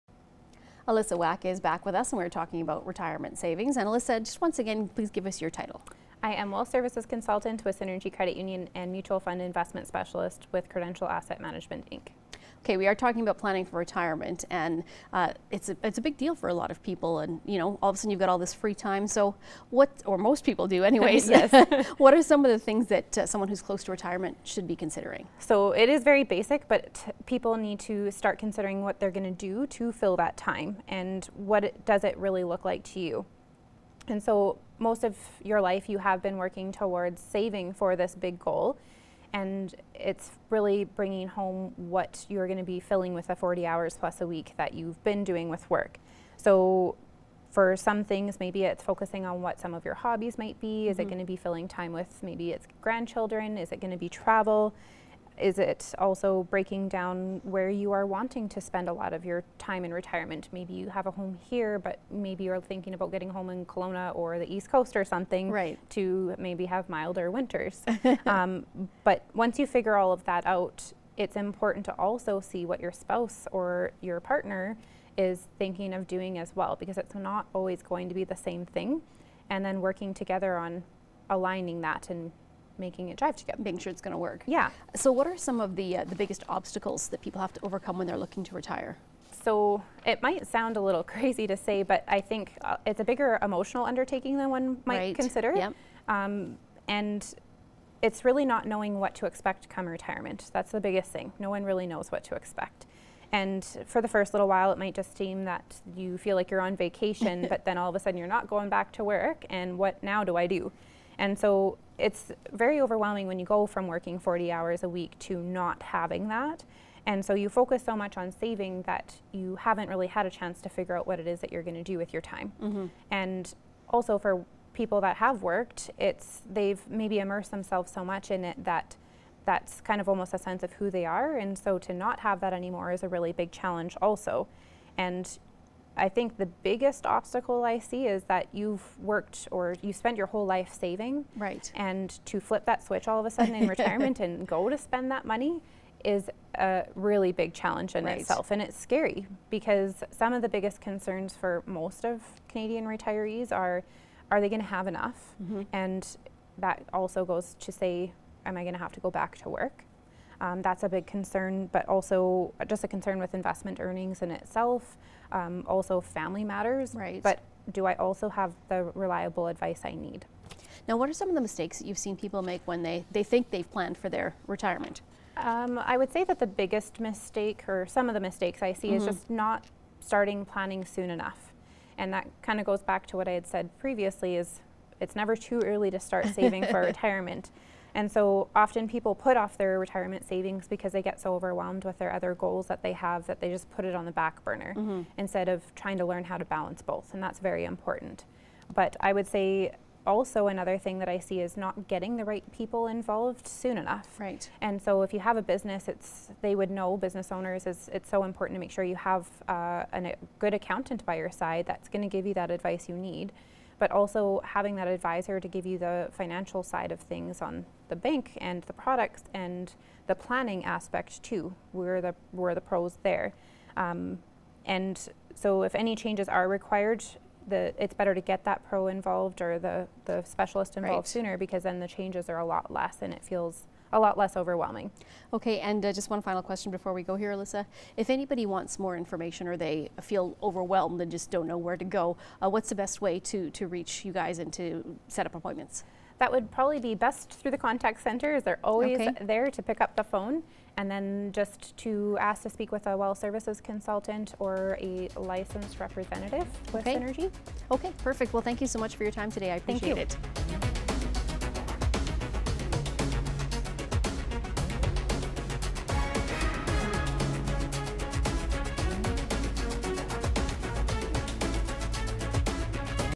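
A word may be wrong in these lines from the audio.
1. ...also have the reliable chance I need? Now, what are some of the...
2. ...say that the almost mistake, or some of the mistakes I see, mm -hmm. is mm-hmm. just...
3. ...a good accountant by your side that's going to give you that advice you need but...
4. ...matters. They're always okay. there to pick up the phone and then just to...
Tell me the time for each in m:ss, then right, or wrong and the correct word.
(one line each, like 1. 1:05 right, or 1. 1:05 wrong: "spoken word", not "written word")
1. 2:47 wrong: "advice", not "chance"
2. 2:56 wrong: "biggest", not "almost"
3. 3:30 right
4. 4:08 wrong: "centers", not "matters".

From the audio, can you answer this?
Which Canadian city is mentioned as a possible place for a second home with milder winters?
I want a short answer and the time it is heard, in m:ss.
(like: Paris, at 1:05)
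Kelowna, at 1:03.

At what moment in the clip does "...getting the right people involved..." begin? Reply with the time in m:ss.
3:21.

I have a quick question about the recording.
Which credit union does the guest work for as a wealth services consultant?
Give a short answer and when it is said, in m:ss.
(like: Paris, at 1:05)
Synergy Credit Union, at 0:07.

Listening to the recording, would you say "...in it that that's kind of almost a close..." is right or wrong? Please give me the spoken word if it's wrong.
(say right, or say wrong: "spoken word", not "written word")
wrong: "sense", not "close".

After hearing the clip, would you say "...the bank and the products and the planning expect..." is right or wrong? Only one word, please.
wrong.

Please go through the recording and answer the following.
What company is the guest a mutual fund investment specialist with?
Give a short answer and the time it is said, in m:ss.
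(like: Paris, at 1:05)
Credential Asset Management, at 0:10.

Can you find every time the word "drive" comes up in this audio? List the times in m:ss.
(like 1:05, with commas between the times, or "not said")
1:23.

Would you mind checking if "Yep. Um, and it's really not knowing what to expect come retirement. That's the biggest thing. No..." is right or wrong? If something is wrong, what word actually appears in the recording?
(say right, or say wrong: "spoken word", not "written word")
right.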